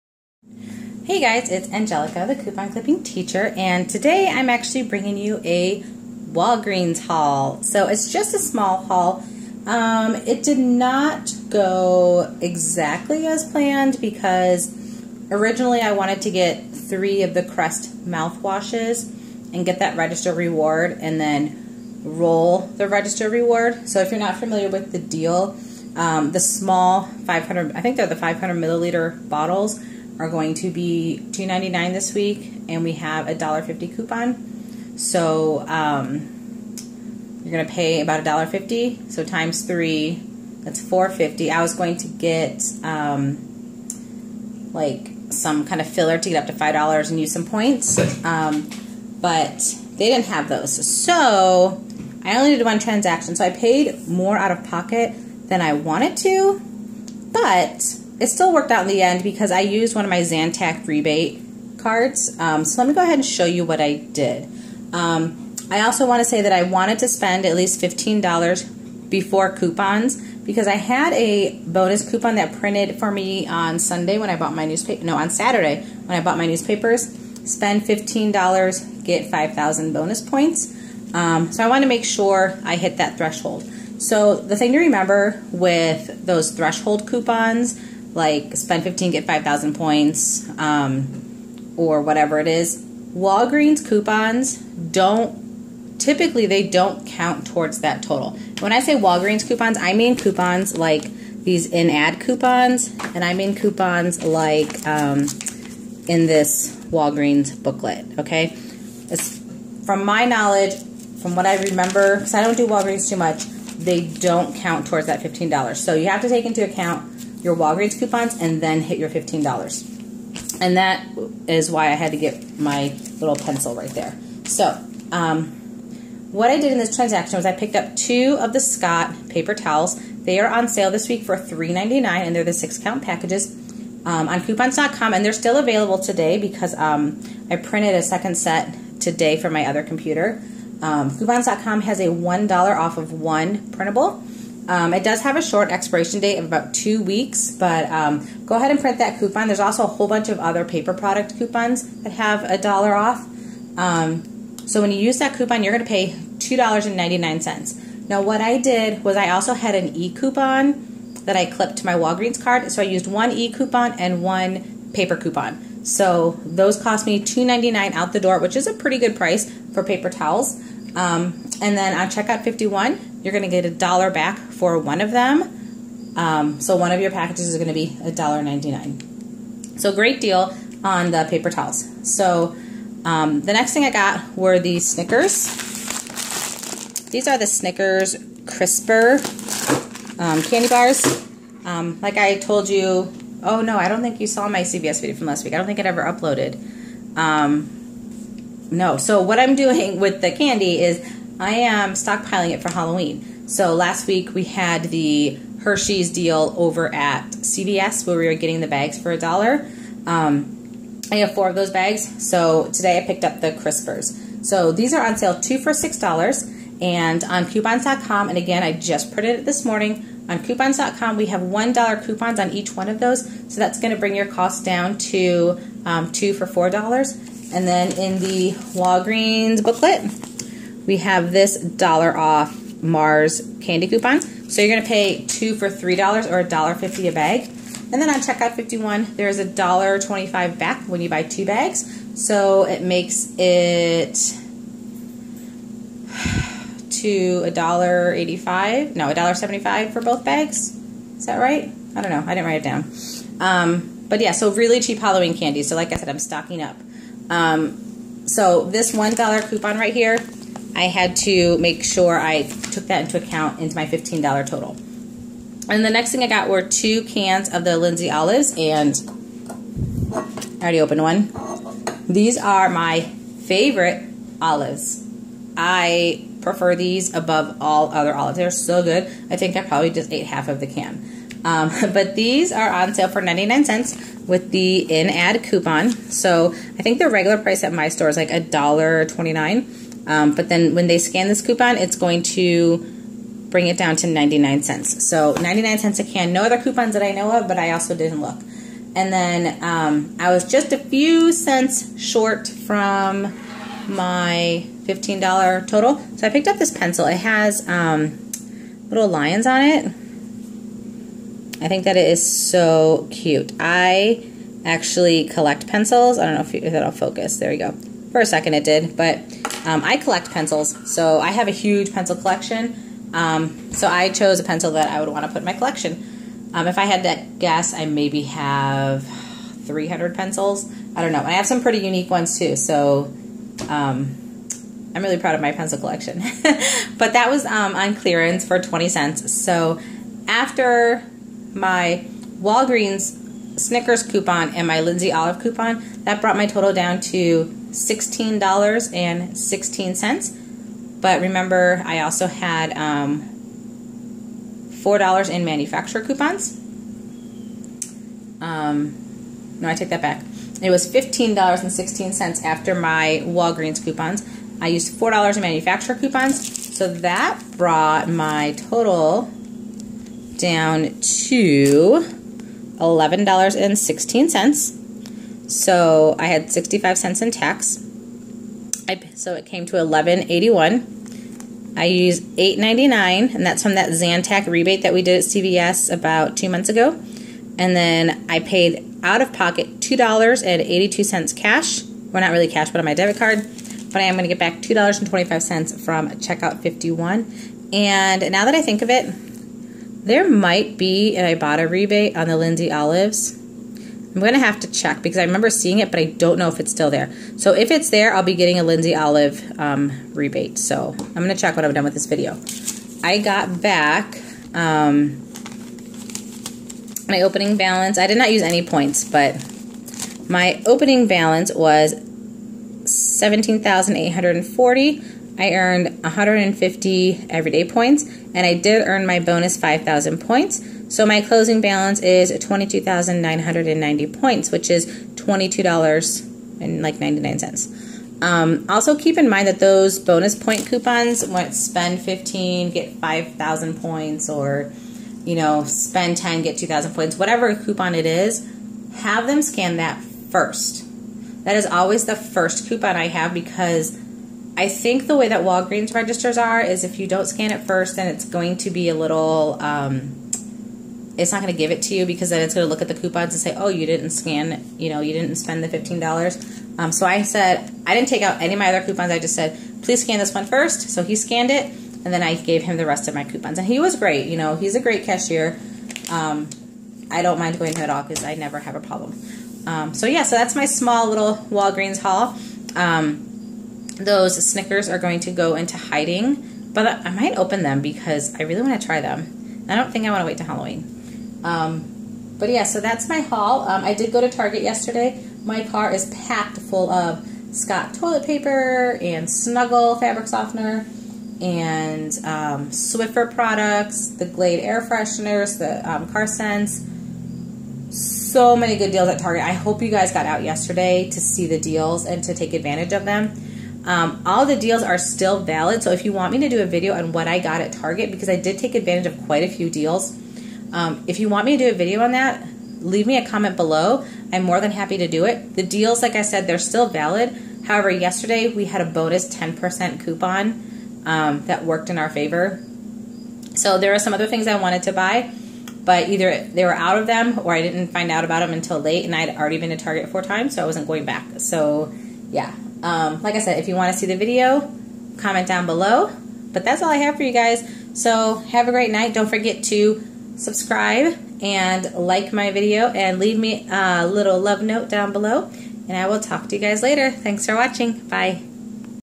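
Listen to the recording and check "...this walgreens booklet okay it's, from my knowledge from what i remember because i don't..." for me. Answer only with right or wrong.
right.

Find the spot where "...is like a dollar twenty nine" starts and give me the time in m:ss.
4:48.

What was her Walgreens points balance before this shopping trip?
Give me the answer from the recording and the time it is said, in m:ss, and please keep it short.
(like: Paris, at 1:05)
17,840, at 7:02.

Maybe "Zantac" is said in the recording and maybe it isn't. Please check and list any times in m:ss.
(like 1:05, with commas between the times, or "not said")
1:00, 6:23.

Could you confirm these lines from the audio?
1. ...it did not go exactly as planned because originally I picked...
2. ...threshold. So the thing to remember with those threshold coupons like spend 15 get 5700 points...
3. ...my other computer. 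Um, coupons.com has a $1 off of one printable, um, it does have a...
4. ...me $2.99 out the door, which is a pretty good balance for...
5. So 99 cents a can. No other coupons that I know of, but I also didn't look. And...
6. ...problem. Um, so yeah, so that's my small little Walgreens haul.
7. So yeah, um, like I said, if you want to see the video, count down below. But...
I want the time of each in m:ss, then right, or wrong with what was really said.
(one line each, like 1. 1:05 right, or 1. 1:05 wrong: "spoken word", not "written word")
1. 0:10 wrong: "wanted", not "picked"
2. 1:23 wrong: "5000", not "5700"
3. 2:19 right
4. 2:47 wrong: "price", not "balance"
5. 4:55 right
6. 7:58 right
7. 9:01 wrong: "comment", not "count".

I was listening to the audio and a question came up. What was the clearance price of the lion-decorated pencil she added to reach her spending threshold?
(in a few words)
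20 cents.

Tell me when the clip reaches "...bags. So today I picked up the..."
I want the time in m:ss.
3:31.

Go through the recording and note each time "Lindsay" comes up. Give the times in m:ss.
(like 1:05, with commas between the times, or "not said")
4:27, 5:44, 6:42, 6:48.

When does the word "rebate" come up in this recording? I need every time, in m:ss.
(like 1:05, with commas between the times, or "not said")
1:00, 6:24, 6:41, 6:50.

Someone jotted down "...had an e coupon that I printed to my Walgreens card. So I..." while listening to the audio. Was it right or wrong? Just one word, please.
wrong.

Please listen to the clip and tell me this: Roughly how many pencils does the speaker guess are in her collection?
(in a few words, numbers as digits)
300.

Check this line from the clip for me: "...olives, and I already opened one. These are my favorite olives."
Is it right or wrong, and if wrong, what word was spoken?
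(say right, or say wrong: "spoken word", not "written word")
right.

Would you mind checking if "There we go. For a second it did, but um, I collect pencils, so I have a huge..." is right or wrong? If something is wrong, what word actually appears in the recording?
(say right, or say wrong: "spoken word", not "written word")
right.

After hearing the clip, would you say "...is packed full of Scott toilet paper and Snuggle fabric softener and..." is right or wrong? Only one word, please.
right.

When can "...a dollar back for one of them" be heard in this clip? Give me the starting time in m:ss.
2:53.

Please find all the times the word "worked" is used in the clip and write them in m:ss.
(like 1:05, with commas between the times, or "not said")
0:58, 8:51.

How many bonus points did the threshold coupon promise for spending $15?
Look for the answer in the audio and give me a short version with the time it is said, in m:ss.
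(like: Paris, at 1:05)
5,000, at 1:19.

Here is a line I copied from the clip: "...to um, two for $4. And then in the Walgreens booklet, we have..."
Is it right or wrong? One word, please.
right.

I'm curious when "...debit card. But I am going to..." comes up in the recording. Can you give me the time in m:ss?
6:32.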